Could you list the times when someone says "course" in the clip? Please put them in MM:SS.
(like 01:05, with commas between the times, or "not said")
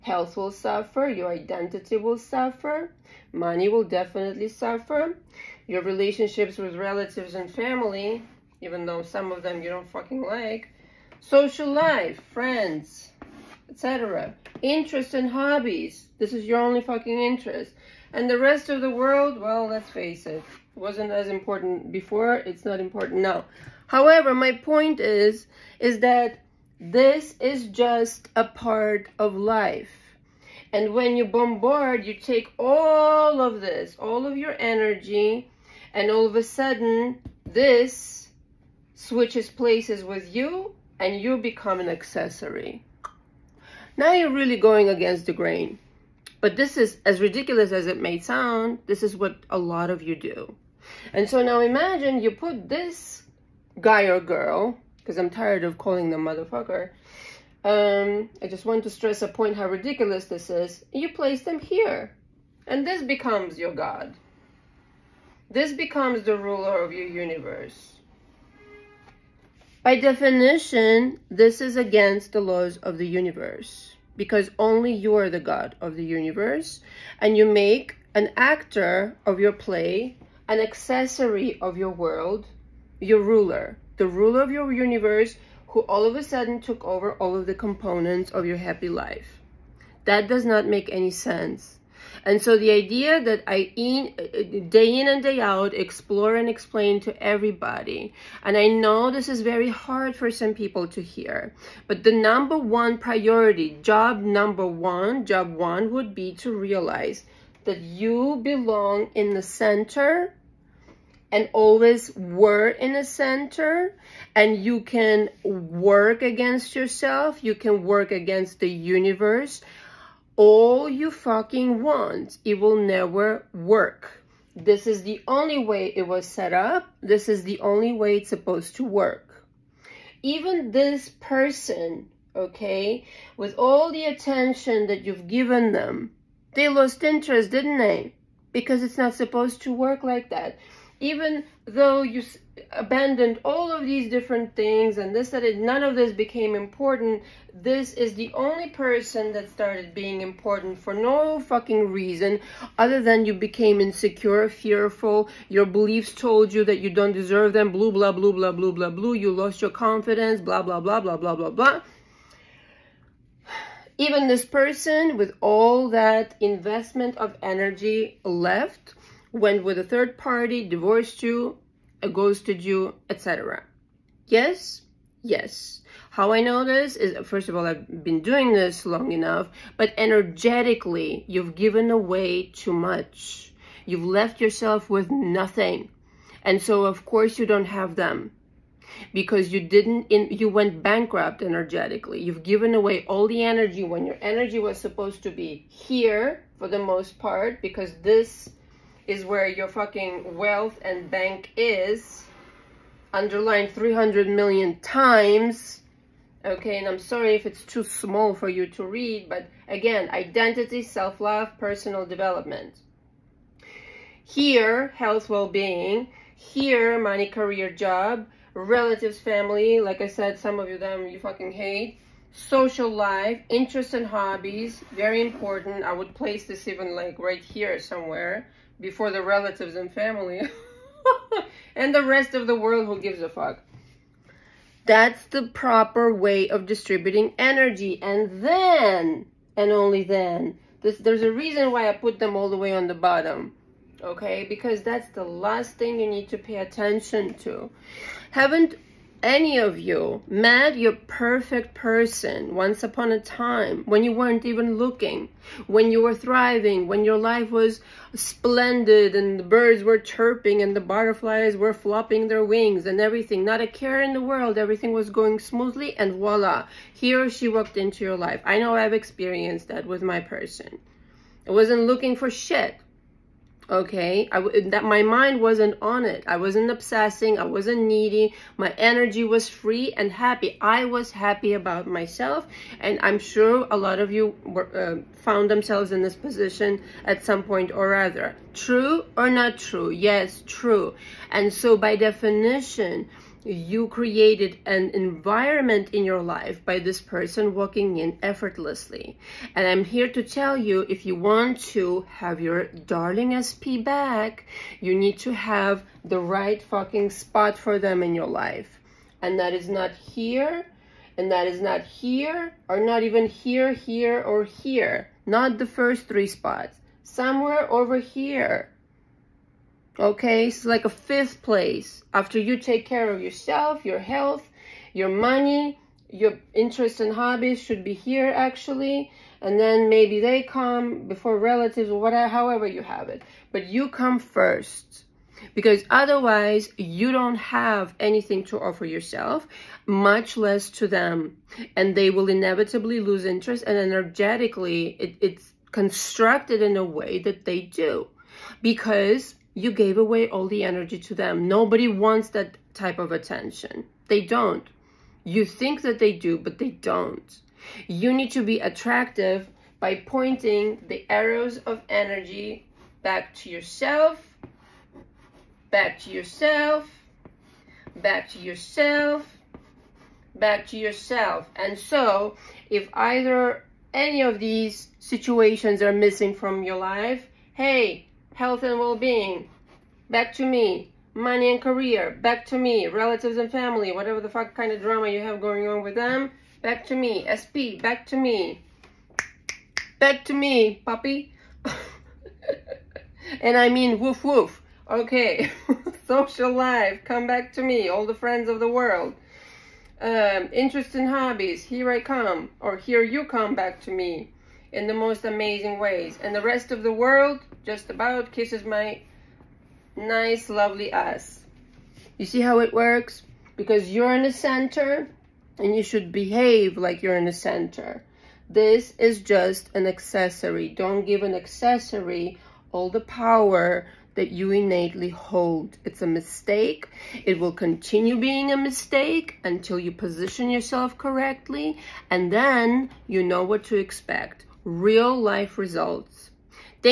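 03:07.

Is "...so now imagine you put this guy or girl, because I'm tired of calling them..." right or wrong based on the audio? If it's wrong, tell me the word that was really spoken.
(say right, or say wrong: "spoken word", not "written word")
right.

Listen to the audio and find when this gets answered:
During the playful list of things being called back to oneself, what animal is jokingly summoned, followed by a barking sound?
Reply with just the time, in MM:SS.
06:30.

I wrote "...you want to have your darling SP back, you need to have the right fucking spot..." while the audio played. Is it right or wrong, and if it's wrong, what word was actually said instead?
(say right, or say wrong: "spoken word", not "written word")
right.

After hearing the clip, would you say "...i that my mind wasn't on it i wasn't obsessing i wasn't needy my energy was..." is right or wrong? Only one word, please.
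right.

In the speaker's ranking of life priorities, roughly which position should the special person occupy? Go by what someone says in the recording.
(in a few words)
fifth place.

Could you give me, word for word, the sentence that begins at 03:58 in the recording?
And then, and only then, this, there's a reason why I put them all the way on the bottom.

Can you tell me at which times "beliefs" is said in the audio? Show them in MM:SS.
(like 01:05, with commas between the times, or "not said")
02:35.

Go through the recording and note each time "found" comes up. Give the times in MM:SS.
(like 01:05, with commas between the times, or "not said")
04:45.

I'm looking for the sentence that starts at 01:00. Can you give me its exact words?
You place them here, and this becomes your god.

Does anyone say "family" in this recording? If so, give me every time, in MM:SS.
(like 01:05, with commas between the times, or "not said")
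00:07, 03:39, 03:49, 06:23.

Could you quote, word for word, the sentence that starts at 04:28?
I know I've experienced that with my person.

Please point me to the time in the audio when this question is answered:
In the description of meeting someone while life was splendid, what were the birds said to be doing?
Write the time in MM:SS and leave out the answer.
04:19.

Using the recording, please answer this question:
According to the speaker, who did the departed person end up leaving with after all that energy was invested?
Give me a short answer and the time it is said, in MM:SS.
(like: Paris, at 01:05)
a third party, at 02:49.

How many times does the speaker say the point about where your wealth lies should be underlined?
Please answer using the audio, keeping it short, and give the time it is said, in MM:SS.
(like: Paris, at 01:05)
300 million, at 03:23.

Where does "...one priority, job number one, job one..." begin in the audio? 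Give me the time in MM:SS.
01:42.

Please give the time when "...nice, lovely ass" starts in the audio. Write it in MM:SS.
06:49.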